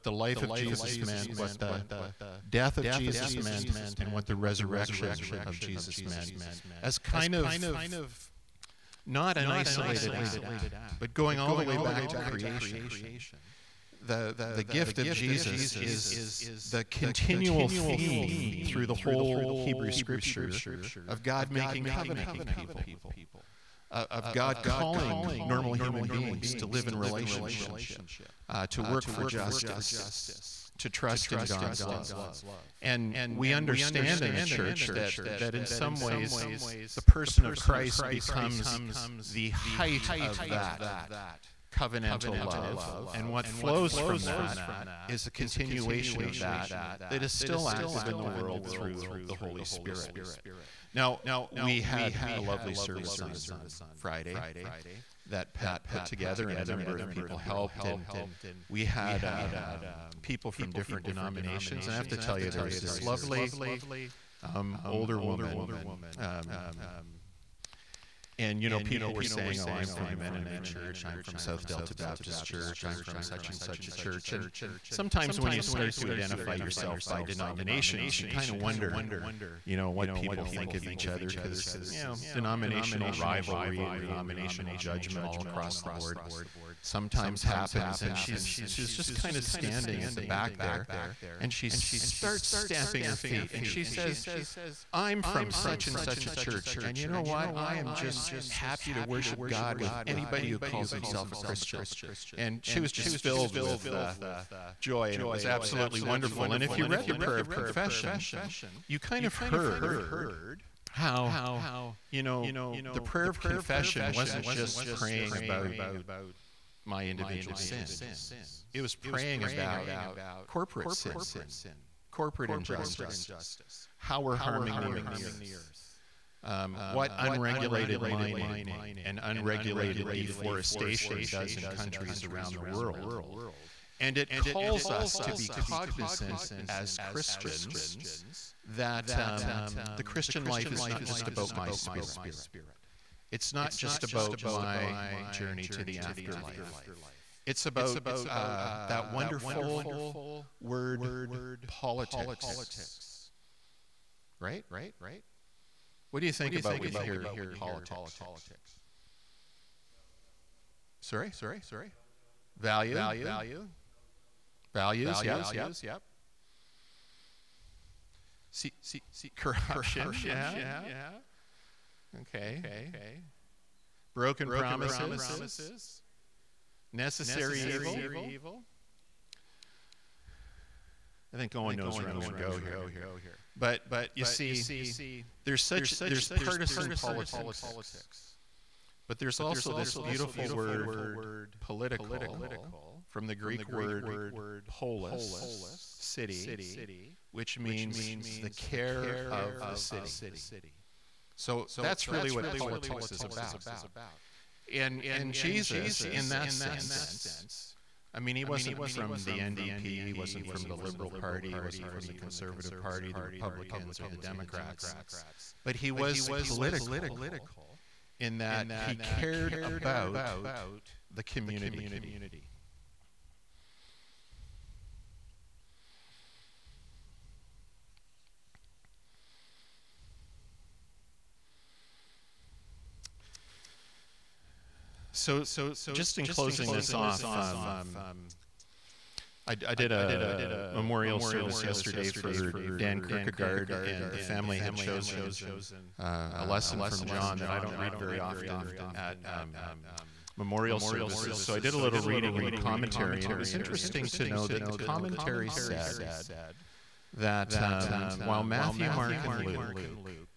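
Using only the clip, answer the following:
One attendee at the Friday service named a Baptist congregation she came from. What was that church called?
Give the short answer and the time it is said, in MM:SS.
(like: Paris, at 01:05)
South Delta Baptist Church, at 01:11.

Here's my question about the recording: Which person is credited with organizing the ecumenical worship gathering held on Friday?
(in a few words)
Pat.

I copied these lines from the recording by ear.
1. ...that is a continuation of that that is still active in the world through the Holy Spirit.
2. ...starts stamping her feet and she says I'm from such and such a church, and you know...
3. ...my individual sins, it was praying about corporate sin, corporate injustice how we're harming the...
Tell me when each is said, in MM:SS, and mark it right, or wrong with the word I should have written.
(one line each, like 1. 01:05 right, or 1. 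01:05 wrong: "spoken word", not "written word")
1. 00:44 right
2. 01:31 right
3. 01:56 right.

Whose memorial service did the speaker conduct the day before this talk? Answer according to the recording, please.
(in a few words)
Dan Kierkegaard.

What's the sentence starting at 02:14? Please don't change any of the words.
And it calls us to be cognizant as Christians that um, the Christian life is not just about my spirit.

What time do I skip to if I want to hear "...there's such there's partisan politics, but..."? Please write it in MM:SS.
03:05.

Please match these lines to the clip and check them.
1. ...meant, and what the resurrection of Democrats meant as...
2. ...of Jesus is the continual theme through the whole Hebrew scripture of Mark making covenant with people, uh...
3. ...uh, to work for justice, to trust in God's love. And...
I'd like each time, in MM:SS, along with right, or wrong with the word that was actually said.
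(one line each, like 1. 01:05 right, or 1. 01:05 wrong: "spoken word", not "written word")
1. 00:03 wrong: "Jesus", not "Democrats"
2. 00:14 wrong: "God", not "Mark"
3. 00:28 right.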